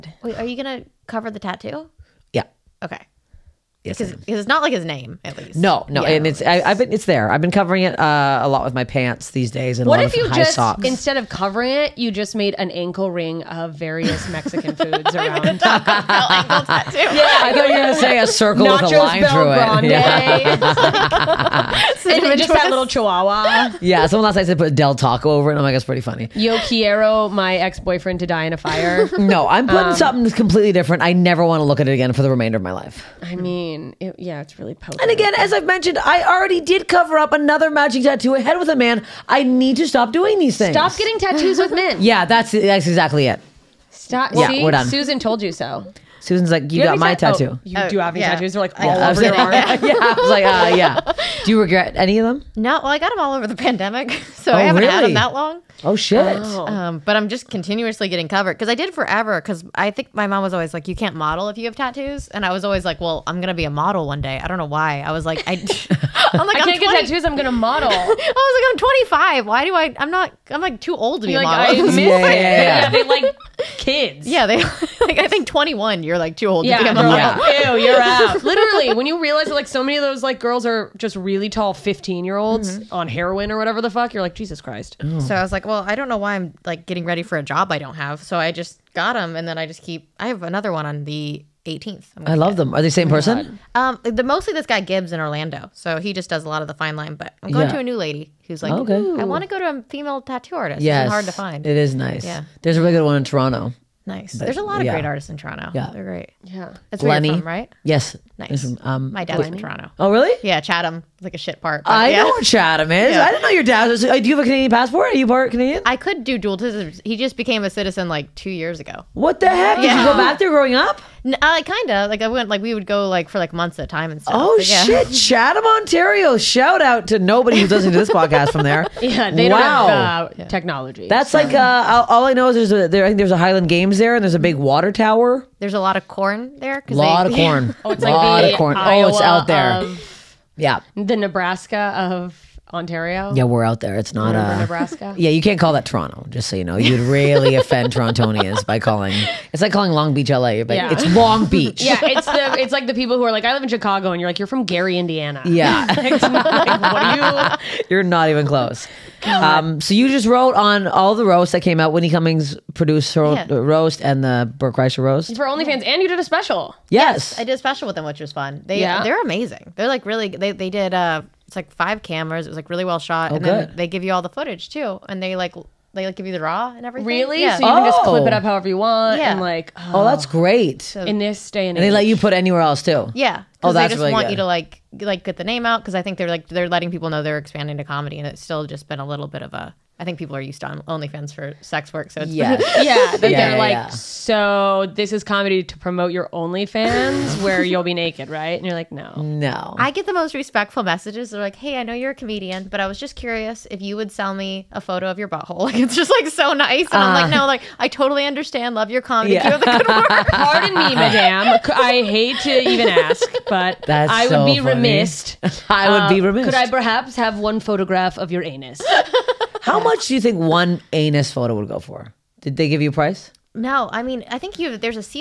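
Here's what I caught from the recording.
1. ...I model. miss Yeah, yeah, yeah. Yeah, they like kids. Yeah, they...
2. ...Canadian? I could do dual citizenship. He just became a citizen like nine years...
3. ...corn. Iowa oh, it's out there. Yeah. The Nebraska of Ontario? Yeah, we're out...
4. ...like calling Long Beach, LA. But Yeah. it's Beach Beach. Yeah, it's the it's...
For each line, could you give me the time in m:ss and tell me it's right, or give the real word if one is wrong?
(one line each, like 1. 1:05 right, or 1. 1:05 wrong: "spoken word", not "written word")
1. 1:11 right
2. 1:55 wrong: "two", not "nine"
3. 2:18 right
4. 2:29 wrong: "Long", not "Beach".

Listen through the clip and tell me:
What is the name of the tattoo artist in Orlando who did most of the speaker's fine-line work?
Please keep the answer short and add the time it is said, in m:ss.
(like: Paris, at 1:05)
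Gibbs, at 1:34.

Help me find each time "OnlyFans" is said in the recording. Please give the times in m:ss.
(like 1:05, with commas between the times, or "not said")
2:45, 3:10, 3:16.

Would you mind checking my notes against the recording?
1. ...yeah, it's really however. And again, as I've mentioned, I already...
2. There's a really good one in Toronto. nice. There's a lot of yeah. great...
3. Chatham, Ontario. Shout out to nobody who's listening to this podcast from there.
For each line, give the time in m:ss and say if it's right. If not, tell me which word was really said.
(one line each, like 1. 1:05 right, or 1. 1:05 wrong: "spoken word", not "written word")
1. 0:34 wrong: "poker", not "however"
2. 1:42 right
3. 2:05 right.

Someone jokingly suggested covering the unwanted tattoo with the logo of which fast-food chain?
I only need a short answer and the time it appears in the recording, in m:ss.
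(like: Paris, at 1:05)
Del Taco, at 0:24.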